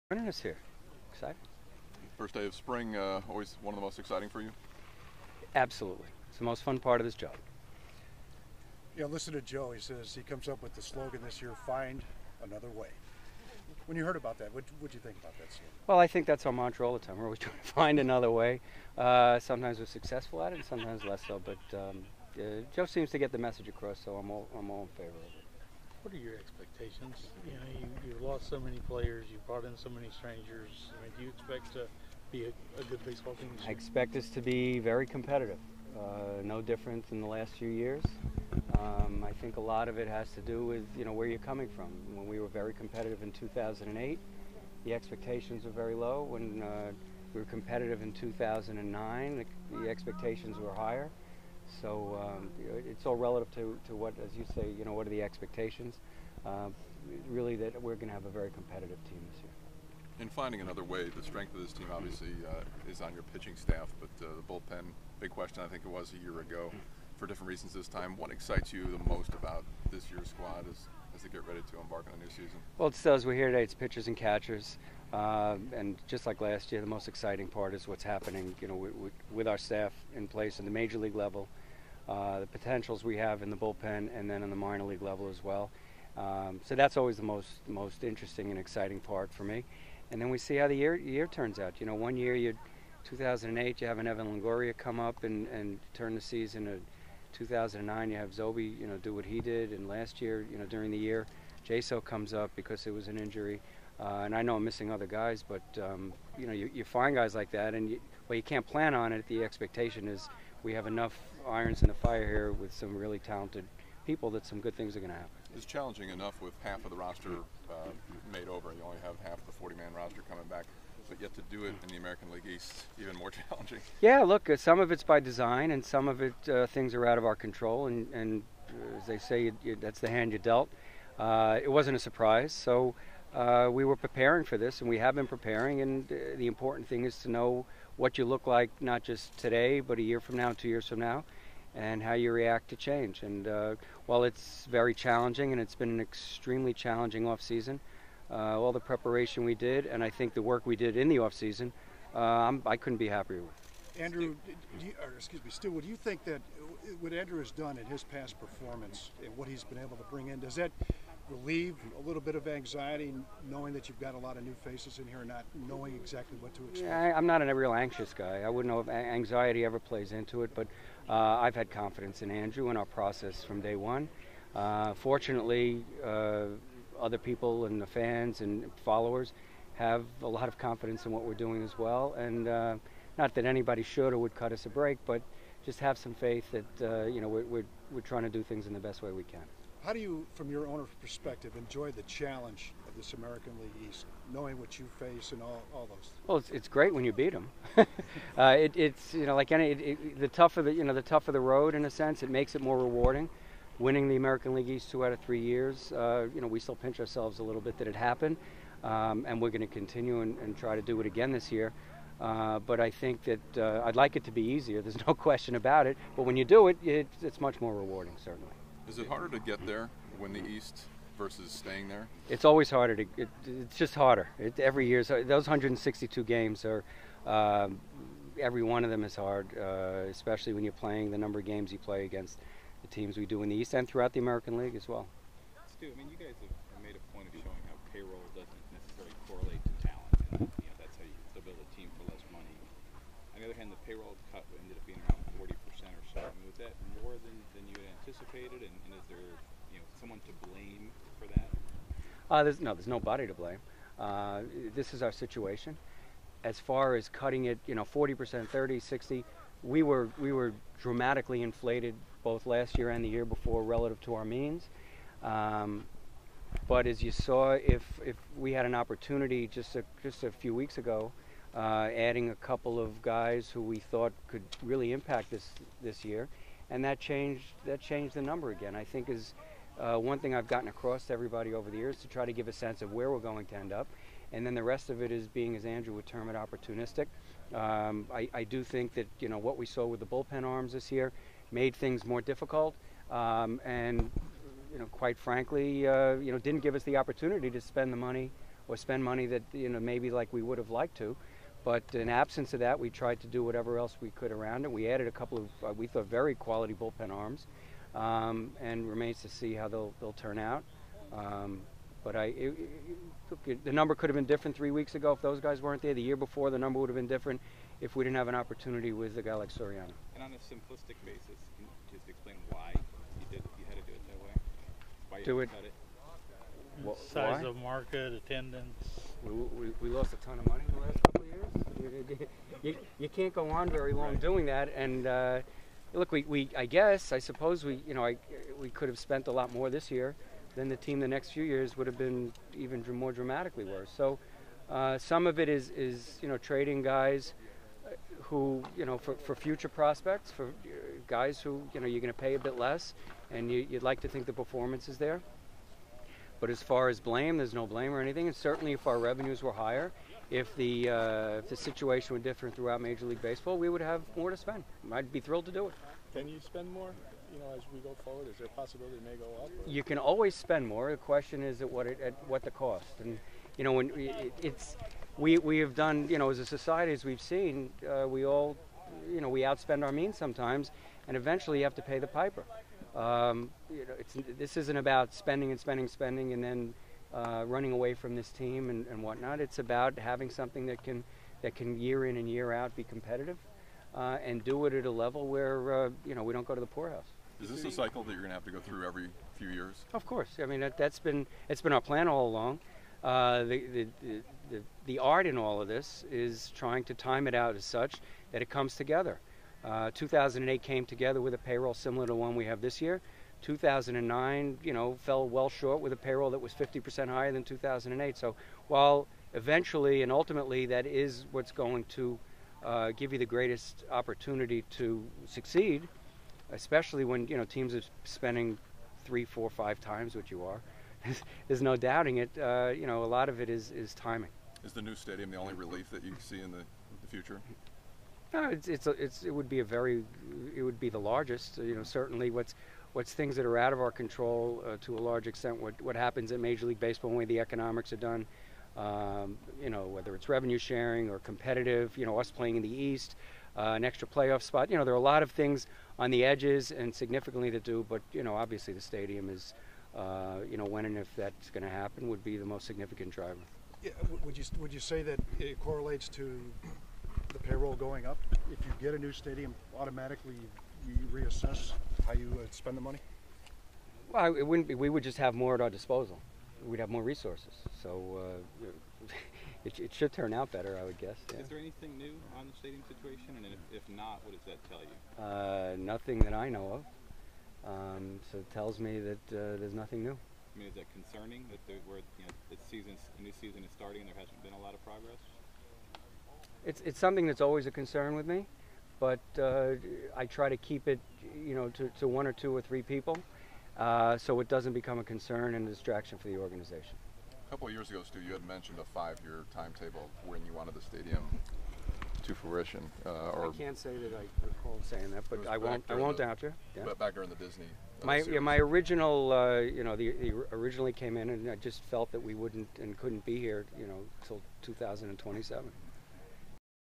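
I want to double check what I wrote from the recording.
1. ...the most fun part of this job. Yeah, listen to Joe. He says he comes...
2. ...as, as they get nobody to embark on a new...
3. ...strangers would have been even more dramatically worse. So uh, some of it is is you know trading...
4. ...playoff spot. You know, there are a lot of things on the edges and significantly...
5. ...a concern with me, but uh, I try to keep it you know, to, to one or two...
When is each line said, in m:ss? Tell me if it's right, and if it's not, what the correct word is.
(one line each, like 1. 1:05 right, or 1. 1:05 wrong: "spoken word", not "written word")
1. 0:06 right
2. 1:10 wrong: "ready", not "nobody"
3. 5:41 wrong: "years", not "strangers"
4. 7:34 right
5. 8:17 right.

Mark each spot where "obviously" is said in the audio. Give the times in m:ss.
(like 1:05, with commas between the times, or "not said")
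1:01, 7:38.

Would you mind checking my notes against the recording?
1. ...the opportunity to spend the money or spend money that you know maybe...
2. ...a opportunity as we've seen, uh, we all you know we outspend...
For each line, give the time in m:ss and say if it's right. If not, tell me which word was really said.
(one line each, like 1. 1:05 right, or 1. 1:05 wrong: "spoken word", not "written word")
1. 4:56 right
2. 6:16 wrong: "society", not "opportunity".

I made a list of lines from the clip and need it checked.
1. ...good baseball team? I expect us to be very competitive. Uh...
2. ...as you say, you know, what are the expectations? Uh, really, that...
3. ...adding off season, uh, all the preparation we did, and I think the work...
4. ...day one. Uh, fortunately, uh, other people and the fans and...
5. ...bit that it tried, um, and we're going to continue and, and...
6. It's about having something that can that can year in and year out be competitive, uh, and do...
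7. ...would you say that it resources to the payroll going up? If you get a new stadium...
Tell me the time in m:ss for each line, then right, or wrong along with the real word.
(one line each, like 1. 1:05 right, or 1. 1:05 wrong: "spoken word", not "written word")
1. 0:32 right
2. 0:54 right
3. 2:26 wrong: "challenging", not "adding"
4. 2:53 right
5. 3:27 wrong: "happened", not "tried"
6. 6:29 right
7. 7:44 wrong: "correlates", not "resources".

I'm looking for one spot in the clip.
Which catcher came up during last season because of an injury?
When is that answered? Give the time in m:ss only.
1:41.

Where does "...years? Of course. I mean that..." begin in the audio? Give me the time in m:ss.
6:39.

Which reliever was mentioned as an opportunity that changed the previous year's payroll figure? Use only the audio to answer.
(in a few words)
Soriano.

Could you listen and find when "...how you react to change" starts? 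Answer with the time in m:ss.
2:22.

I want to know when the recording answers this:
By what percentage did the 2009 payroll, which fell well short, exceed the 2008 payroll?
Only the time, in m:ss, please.
6:56.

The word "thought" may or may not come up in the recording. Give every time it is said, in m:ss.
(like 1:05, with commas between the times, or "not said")
4:33, 5:05.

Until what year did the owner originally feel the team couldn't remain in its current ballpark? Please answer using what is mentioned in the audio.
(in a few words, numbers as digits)
2027.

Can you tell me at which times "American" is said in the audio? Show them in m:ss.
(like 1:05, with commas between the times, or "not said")
2:01, 3:13, 3:24, 3:54.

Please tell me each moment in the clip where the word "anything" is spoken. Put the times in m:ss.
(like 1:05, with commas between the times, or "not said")
5:58, 8:01.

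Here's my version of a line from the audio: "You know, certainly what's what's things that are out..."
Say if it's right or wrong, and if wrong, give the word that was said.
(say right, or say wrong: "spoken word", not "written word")
right.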